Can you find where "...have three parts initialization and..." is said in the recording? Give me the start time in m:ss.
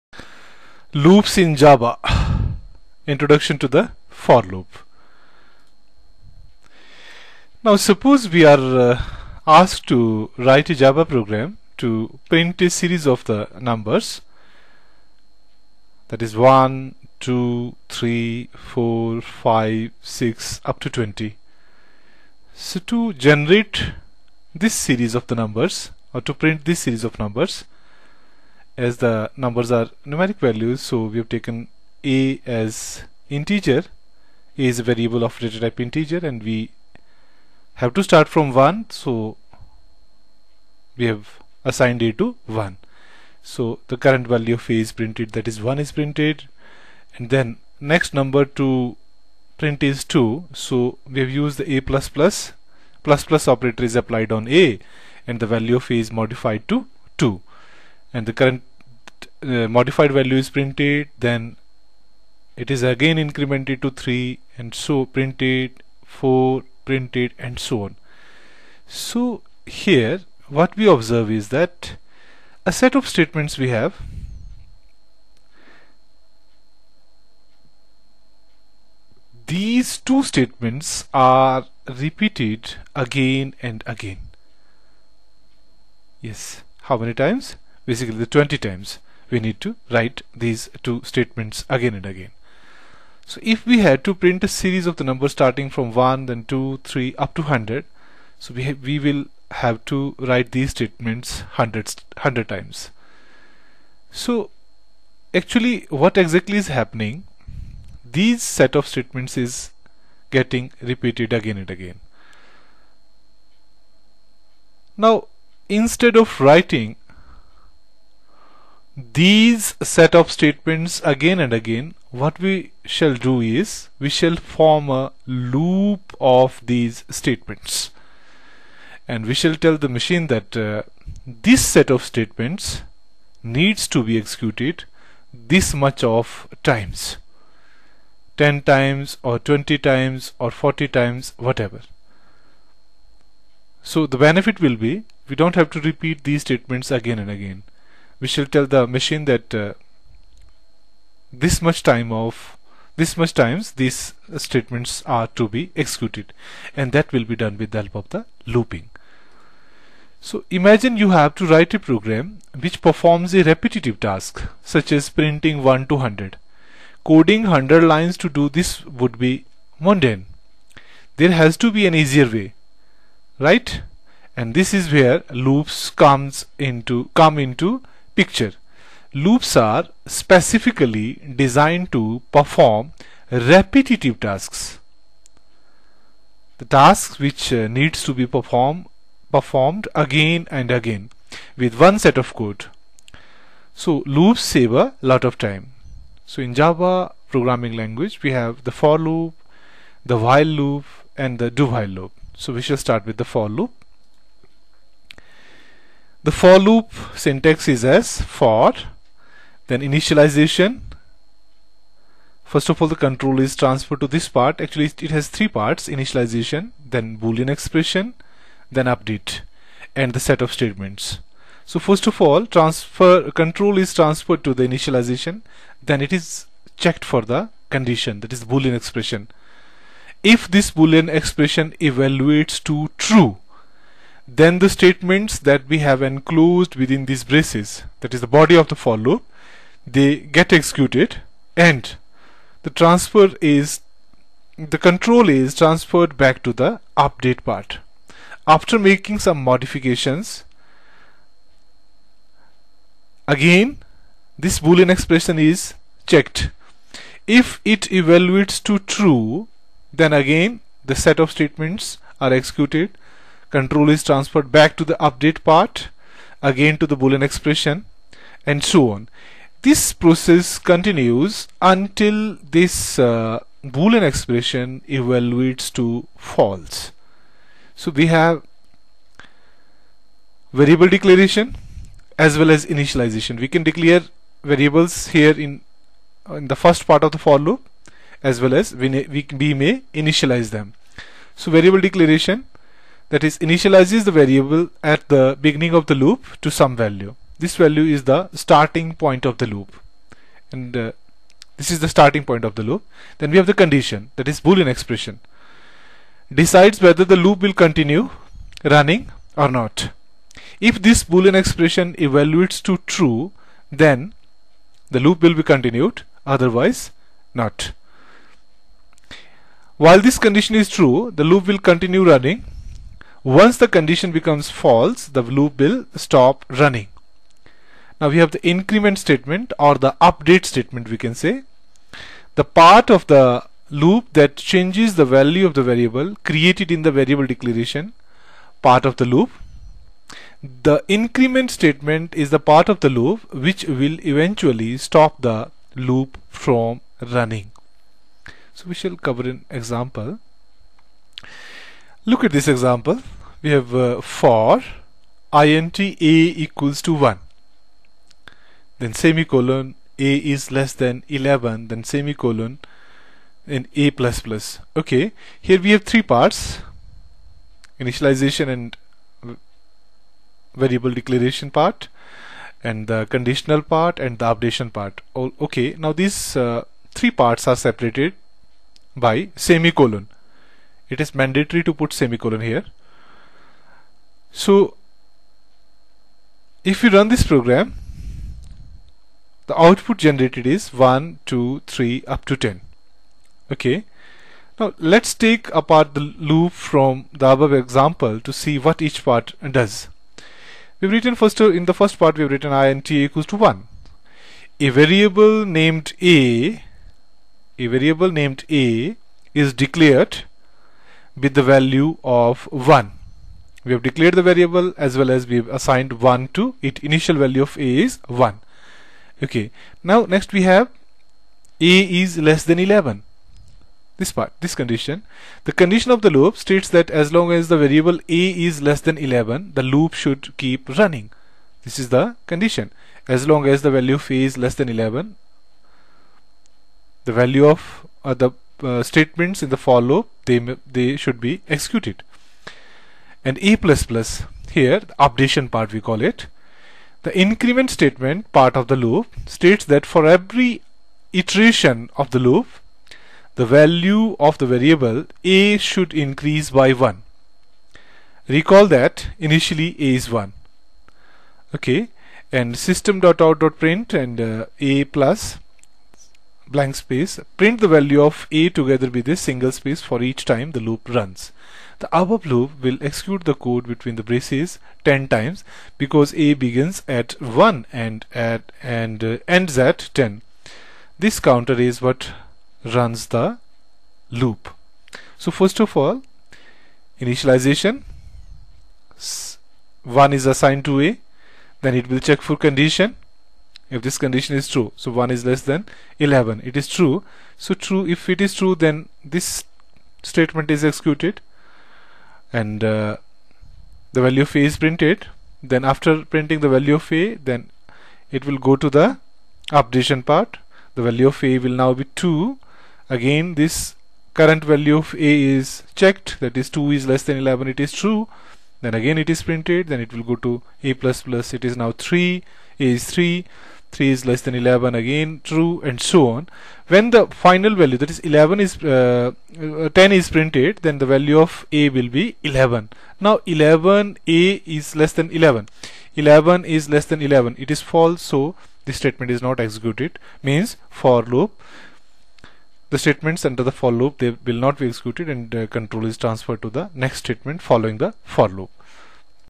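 6:05.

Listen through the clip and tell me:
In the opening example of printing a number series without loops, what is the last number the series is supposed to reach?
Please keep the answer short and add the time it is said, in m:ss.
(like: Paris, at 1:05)
20, at 0:20.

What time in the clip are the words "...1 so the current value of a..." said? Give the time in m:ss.
0:42.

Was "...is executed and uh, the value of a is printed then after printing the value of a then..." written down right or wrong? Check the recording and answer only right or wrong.
right.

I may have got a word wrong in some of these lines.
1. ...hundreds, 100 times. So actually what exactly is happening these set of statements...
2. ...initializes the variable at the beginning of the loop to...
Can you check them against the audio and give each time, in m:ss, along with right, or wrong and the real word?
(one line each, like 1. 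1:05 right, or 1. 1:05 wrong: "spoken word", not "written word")
1. 1:41 right
2. 4:53 right.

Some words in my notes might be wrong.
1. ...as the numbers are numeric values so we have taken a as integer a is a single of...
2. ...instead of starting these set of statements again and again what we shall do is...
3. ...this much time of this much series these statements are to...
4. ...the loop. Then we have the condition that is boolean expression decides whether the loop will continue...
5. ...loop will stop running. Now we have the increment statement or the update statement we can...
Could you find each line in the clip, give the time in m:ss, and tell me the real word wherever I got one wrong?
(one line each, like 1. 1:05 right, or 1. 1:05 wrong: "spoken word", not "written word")
1. 0:28 wrong: "variable", not "single"
2. 1:55 wrong: "writing", not "starting"
3. 2:31 wrong: "times", not "series"
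4. 5:02 right
5. 5:25 right.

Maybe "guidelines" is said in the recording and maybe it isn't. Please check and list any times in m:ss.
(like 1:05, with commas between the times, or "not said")
not said.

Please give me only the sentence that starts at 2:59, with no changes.
Loops are specifically designed to perform repetitive tasks.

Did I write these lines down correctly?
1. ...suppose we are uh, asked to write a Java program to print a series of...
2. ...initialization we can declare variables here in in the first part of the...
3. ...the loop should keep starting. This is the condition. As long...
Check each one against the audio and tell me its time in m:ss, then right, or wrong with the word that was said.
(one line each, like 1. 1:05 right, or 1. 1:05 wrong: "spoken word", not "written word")
1. 0:07 right
2. 4:42 right
3. 7:09 wrong: "running", not "starting".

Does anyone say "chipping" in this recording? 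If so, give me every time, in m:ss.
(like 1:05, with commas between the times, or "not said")
not said.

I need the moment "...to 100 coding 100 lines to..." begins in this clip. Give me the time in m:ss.
2:45.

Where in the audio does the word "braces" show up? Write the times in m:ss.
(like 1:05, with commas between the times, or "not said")
3:57, 7:54.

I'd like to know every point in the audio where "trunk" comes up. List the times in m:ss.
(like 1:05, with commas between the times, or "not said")
not said.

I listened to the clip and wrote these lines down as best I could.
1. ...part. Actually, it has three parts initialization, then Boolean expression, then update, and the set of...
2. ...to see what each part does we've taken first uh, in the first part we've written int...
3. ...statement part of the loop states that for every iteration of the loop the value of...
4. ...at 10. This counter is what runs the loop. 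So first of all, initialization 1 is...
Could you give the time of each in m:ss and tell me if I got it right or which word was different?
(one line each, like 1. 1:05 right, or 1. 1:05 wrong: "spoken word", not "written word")
1. 3:34 right
2. 6:38 wrong: "written", not "taken"
3. 7:27 right
4. 7:59 right.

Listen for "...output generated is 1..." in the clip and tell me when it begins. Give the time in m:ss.
6:29.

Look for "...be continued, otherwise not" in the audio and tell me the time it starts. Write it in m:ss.
5:15.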